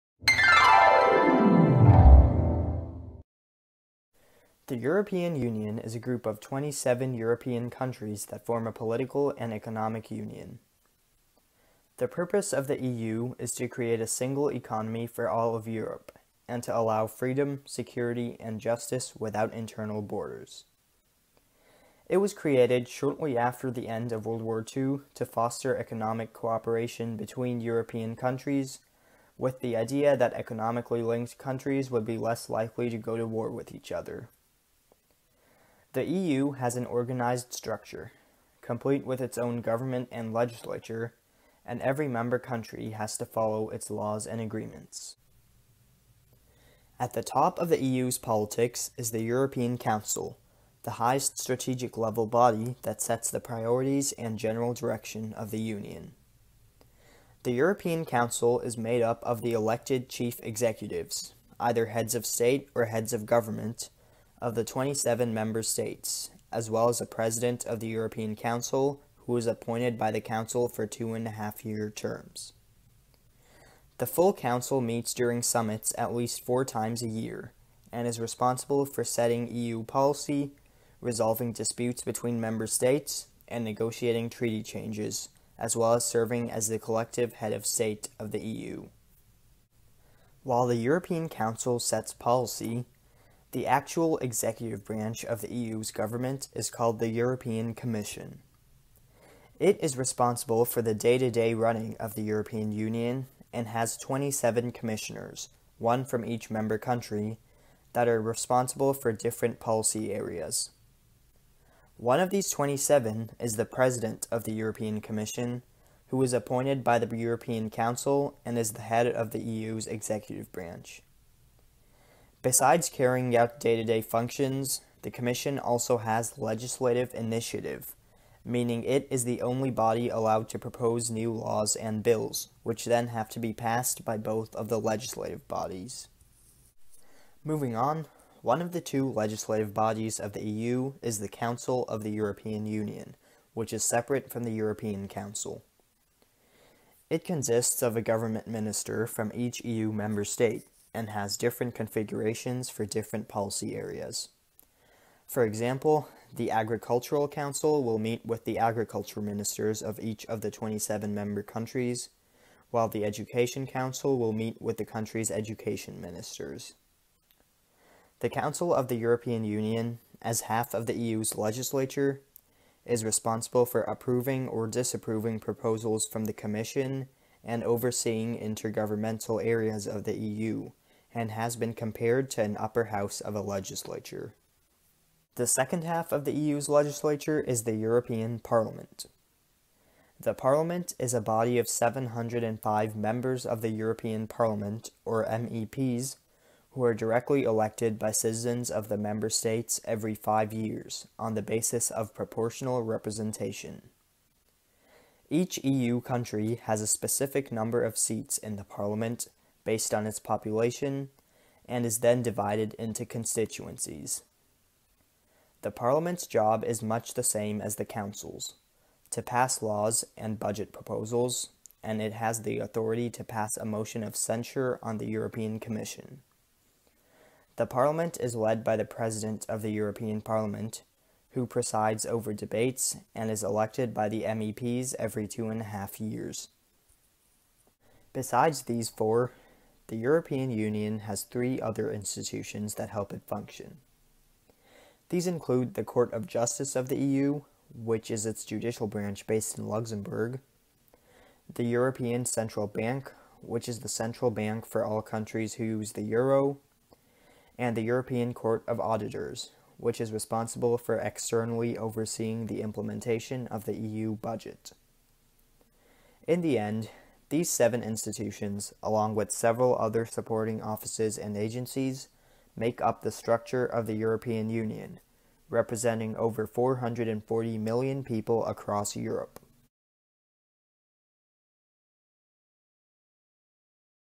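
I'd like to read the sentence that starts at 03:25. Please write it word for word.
Each EU country has a specific number of seats in the Parliament based on its population and is then divided into constituencies.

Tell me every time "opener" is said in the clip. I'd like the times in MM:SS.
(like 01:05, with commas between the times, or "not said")
not said.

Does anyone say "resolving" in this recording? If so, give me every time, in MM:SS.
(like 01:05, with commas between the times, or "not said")
01:21.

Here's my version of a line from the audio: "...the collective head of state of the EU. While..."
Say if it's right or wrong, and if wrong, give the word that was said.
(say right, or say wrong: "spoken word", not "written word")
right.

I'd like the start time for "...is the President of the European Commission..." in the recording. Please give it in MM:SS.
01:53.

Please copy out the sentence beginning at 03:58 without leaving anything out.
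Besides these four, the European Union has three other institutions that help it function.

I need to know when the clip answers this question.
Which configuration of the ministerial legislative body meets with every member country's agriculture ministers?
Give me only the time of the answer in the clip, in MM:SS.
02:36.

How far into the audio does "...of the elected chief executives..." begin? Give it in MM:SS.
00:59.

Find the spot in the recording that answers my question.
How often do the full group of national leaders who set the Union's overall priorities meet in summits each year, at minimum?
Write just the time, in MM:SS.
01:16.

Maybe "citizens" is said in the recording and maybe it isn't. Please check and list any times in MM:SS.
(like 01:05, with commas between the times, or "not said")
03:18.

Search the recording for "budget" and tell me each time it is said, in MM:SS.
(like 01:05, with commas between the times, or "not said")
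03:40, 04:24.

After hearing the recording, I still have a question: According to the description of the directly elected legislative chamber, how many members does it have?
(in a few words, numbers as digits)
705.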